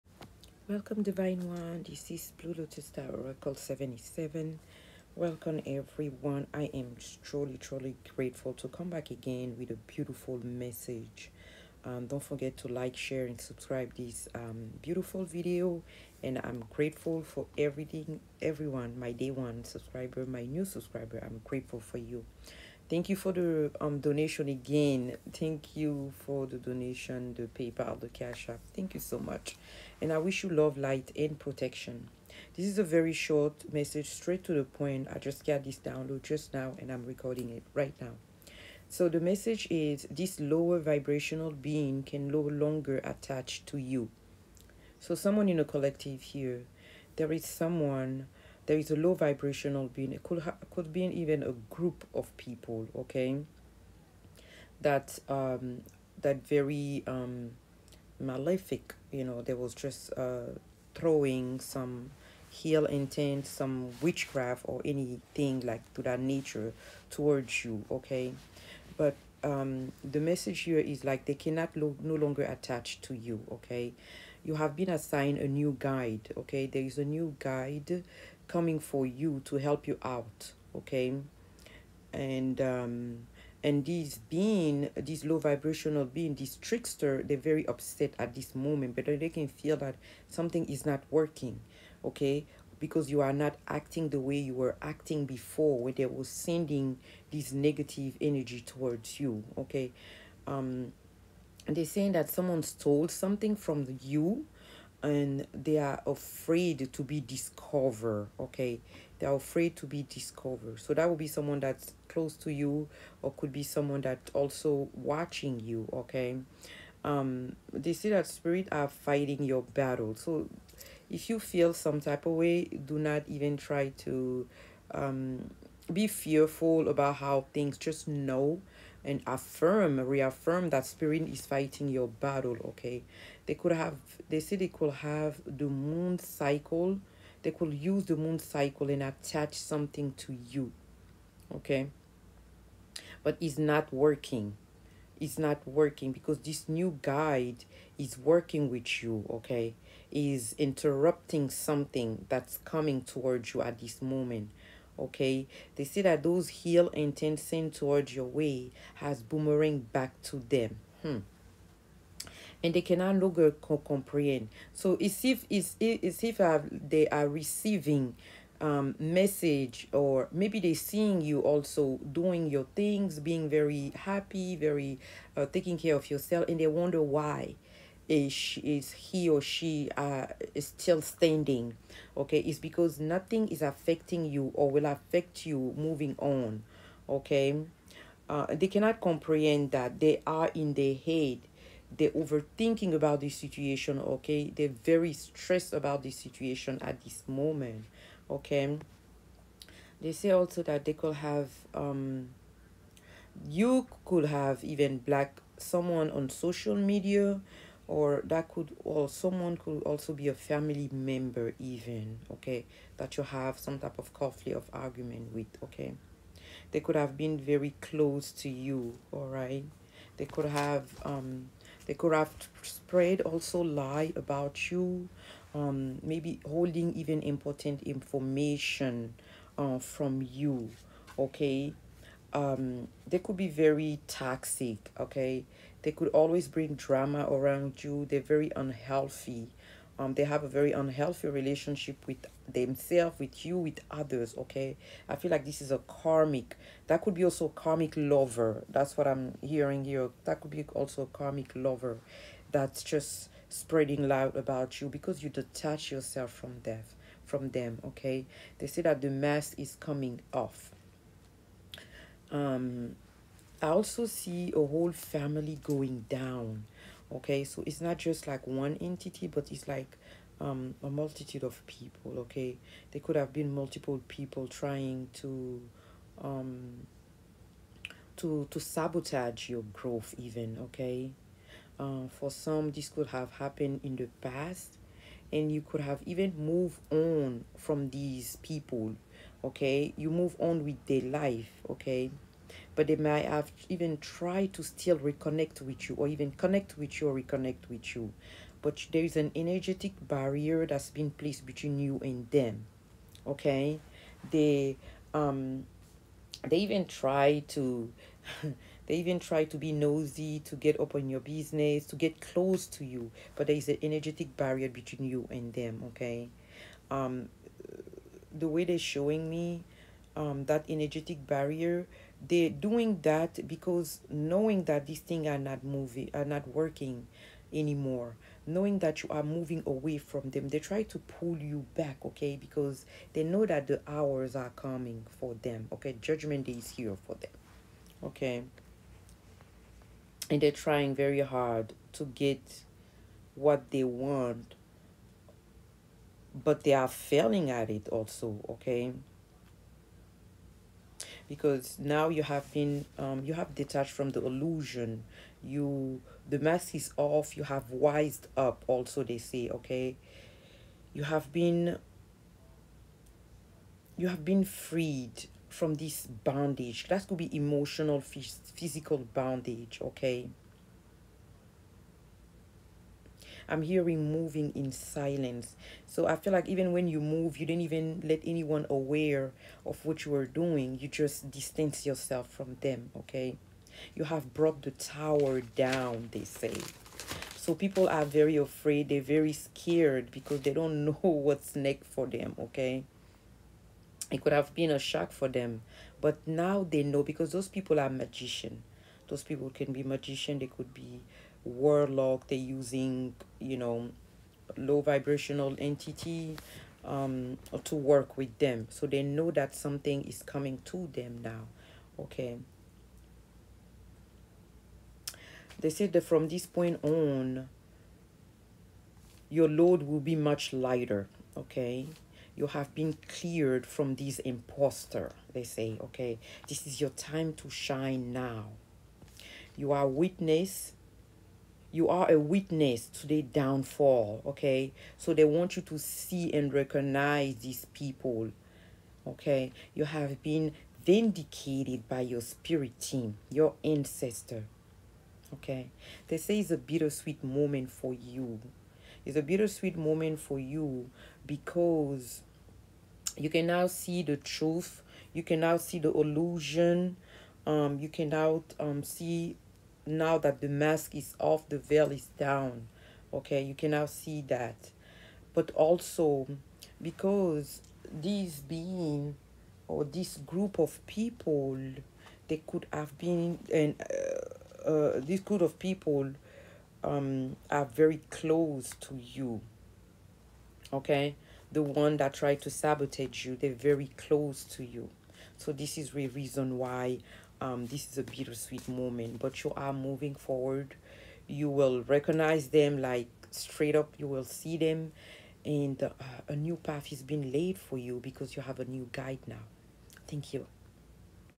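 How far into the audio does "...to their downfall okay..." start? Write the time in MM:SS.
07:12.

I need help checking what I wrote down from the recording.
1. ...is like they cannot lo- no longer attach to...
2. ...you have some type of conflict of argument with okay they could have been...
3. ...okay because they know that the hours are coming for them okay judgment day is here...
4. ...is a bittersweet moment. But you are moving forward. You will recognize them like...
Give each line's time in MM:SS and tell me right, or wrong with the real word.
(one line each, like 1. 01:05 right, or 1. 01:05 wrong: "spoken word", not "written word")
1. 01:10 right
2. 03:33 right
3. 05:32 right
4. 08:07 right.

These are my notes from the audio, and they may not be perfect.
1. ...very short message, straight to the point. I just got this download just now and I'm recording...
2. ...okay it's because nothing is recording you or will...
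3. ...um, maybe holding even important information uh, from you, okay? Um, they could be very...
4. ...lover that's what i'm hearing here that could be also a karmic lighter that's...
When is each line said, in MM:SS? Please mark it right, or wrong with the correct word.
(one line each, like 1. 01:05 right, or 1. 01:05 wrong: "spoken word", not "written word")
1. 00:32 right
2. 03:02 wrong: "affecting", not "recording"
3. 03:45 right
4. 04:07 wrong: "lover", not "lighter".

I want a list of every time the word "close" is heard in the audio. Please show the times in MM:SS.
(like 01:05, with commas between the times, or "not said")
01:52, 03:37, 05:12, 07:58, 08:03.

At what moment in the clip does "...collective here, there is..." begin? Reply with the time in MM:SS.
00:45.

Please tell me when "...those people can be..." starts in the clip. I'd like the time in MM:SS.
06:39.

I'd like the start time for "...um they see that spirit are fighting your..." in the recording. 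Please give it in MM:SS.
01:57.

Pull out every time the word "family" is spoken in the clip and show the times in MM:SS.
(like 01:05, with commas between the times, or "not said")
03:30, 04:24.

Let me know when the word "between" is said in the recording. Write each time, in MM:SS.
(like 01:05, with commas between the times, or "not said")
05:01, 05:14.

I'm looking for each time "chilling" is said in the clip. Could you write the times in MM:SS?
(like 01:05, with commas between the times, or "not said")
not said.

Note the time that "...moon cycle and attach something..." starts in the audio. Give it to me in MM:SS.
02:18.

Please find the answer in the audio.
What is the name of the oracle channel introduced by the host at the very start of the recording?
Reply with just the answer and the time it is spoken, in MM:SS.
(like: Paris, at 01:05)
Blue Lotus Star Oracle 77, at 00:02.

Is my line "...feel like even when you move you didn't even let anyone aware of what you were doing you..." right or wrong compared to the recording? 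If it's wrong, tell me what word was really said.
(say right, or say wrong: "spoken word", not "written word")
right.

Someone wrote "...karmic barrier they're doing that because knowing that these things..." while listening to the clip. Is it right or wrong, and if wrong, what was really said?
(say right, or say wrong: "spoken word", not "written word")
wrong: "energetic", not "karmic".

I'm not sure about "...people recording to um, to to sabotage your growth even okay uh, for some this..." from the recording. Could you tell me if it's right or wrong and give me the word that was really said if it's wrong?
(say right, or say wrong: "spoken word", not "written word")
wrong: "trying", not "recording".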